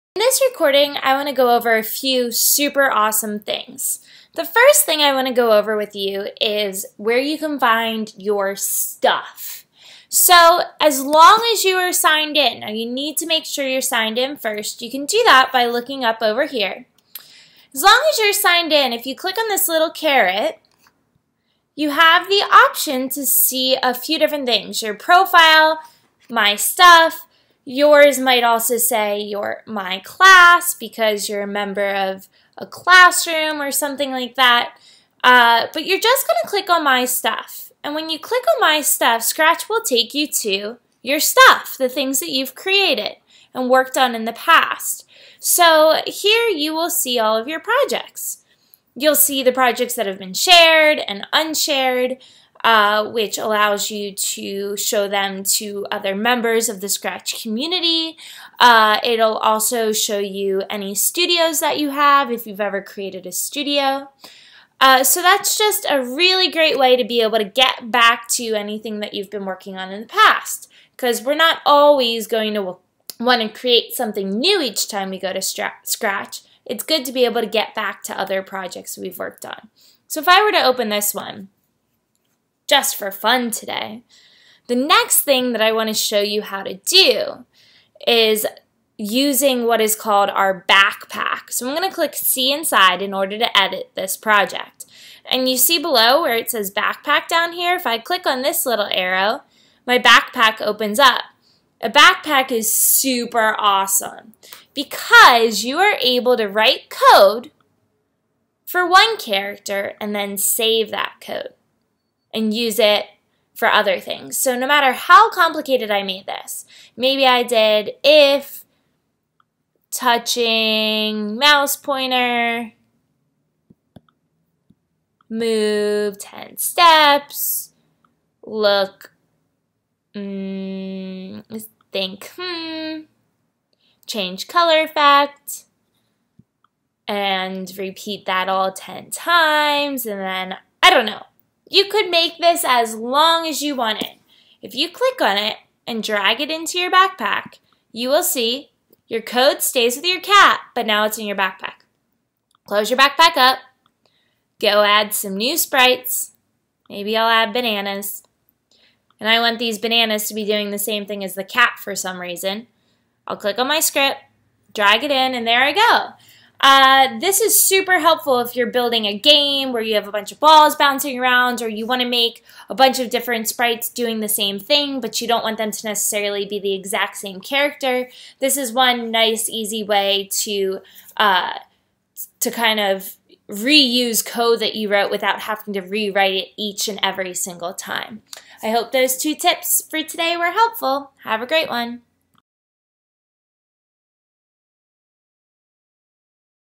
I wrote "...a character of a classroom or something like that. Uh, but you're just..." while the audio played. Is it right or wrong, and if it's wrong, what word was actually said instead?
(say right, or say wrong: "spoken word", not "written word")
wrong: "member", not "character".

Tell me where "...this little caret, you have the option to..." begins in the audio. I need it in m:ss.
0:19.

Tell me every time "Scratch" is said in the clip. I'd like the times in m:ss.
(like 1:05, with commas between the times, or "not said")
0:39, 0:56, 1:15.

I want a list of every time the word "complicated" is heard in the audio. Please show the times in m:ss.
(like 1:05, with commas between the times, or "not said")
1:55.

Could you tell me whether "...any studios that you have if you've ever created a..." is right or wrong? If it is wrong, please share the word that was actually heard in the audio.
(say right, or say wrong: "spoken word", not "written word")
right.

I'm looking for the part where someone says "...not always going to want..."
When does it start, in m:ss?
1:11.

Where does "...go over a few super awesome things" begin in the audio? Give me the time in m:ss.
0:01.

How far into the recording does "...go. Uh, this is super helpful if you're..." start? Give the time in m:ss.
2:45.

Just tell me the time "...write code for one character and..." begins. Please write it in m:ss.
1:46.